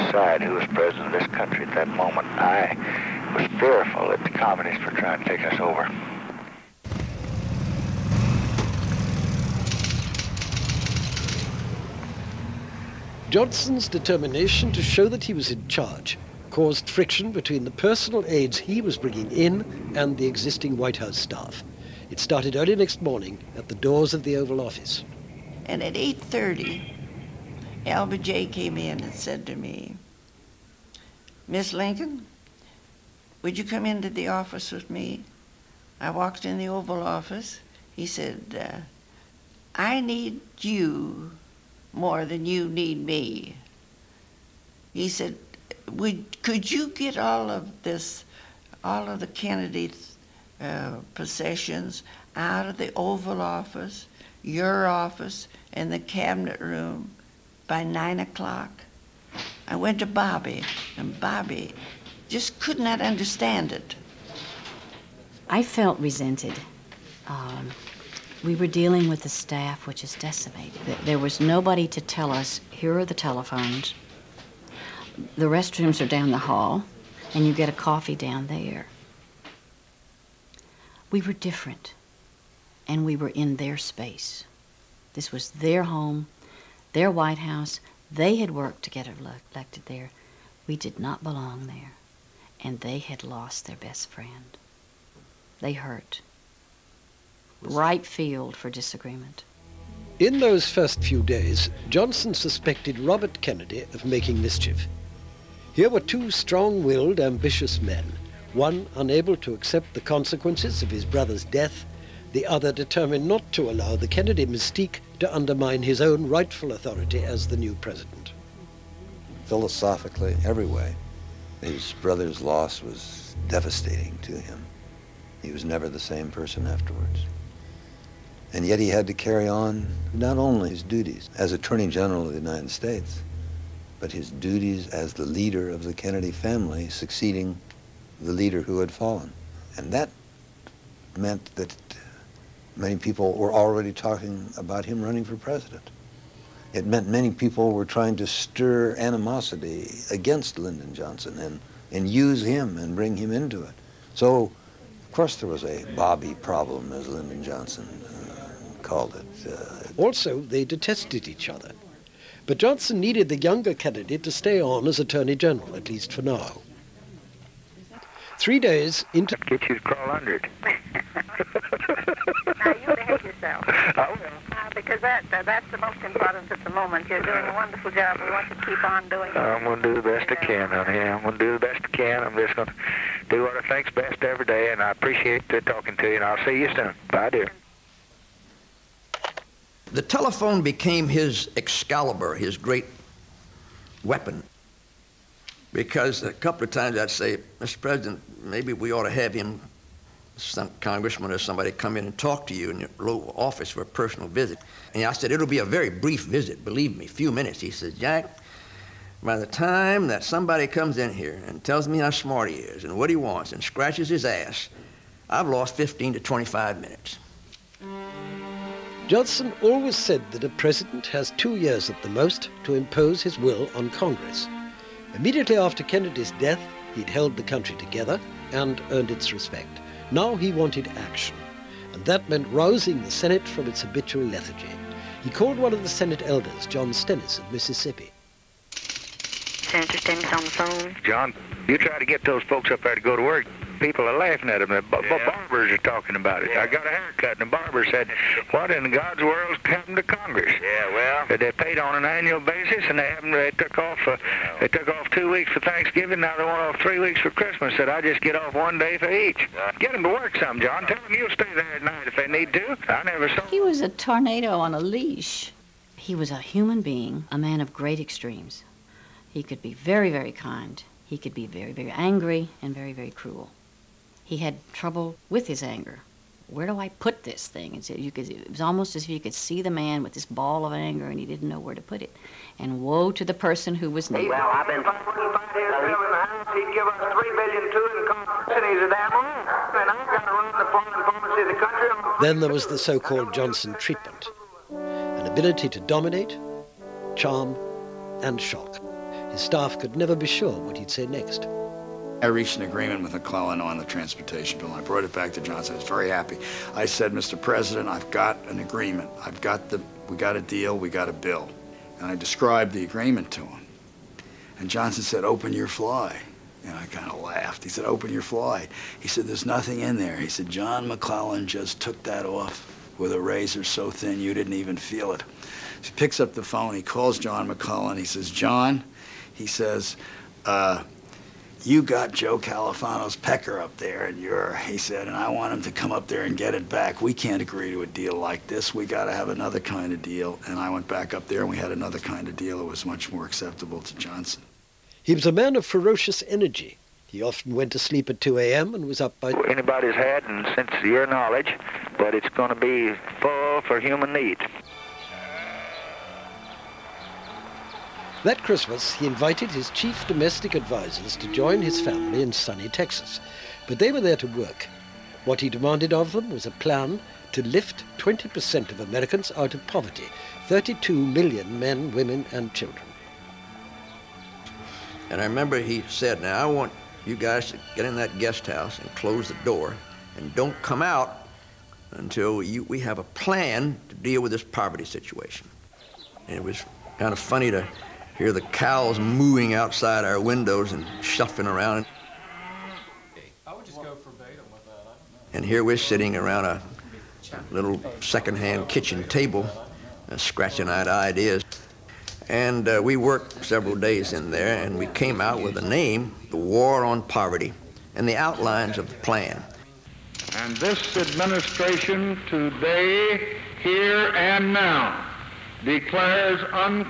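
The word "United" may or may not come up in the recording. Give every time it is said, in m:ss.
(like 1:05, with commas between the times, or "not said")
2:12.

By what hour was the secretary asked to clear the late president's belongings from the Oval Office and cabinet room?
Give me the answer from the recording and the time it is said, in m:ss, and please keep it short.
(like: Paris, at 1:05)
9 o'clock, at 0:57.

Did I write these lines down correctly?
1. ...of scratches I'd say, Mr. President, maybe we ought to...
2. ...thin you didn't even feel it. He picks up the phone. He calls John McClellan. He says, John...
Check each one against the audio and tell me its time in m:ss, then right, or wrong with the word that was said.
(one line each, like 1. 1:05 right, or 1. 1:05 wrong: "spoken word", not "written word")
1. 3:16 wrong: "times", not "scratches"
2. 5:23 right.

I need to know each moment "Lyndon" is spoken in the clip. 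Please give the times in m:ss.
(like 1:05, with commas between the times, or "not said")
2:30, 2:37.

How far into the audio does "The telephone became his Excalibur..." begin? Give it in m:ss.
3:09.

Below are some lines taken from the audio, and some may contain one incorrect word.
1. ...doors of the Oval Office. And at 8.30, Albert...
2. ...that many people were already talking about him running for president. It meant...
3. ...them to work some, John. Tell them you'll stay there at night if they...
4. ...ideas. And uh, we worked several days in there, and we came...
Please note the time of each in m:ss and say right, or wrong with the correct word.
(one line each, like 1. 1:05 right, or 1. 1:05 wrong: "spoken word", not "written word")
1. 0:23 right
2. 2:21 right
3. 4:19 right
4. 6:40 right.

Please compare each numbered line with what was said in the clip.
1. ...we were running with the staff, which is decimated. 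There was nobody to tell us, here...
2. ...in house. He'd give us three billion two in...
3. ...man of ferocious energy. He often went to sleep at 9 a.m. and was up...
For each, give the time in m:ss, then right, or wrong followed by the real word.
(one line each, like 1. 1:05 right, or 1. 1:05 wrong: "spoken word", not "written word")
1. 1:08 wrong: "dealing", not "running"
2. 4:44 right
3. 5:45 wrong: "2", not "9".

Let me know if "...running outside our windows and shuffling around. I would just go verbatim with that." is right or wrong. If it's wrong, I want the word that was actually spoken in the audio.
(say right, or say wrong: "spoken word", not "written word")
wrong: "mooing", not "running".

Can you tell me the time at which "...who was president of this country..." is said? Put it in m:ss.
0:00.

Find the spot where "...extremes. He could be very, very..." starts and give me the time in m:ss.
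4:27.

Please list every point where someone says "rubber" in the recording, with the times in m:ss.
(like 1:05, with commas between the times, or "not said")
not said.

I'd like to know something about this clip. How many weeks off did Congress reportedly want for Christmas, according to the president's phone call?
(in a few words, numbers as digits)
3 weeks.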